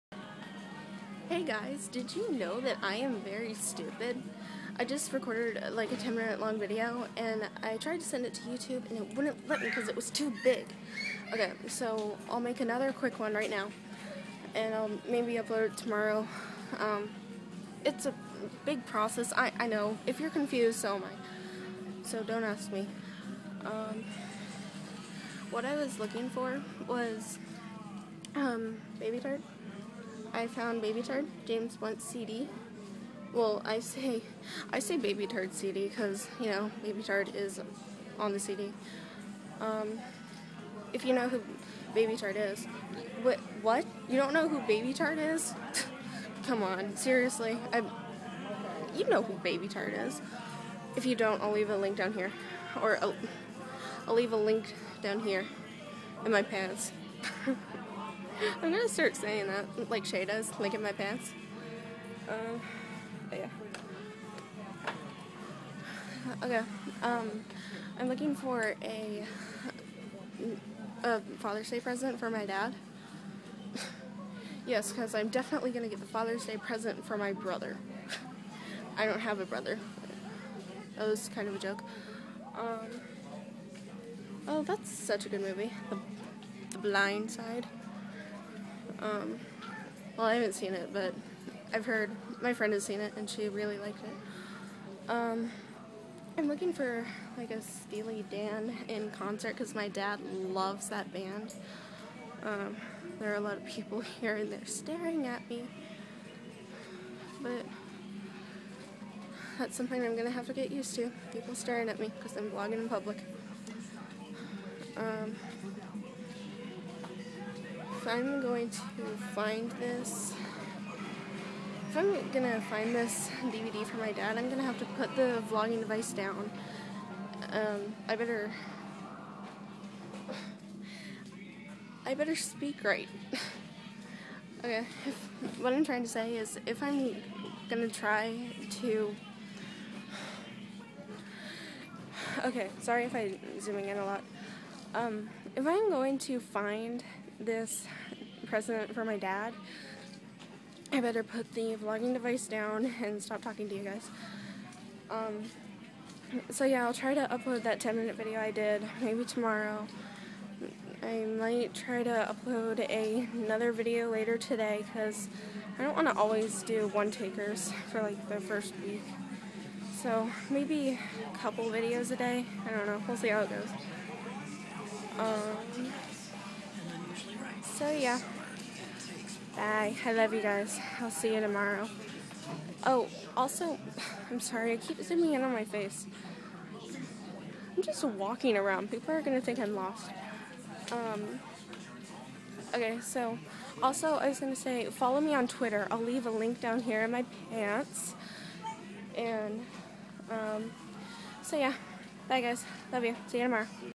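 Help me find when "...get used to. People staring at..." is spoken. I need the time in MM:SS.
01:50.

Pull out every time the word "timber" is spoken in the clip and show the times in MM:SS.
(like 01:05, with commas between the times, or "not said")
not said.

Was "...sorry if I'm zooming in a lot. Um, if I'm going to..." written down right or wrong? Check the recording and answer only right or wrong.
right.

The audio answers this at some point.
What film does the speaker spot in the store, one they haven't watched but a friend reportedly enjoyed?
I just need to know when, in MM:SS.
01:26.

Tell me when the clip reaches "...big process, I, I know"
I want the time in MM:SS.
00:18.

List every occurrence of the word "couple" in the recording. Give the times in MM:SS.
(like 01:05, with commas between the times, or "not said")
02:51.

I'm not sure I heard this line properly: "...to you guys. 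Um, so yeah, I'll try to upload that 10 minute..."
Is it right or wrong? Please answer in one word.
right.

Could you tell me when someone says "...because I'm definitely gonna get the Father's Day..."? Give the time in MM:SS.
01:14.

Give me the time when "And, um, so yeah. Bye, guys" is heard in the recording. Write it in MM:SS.
03:19.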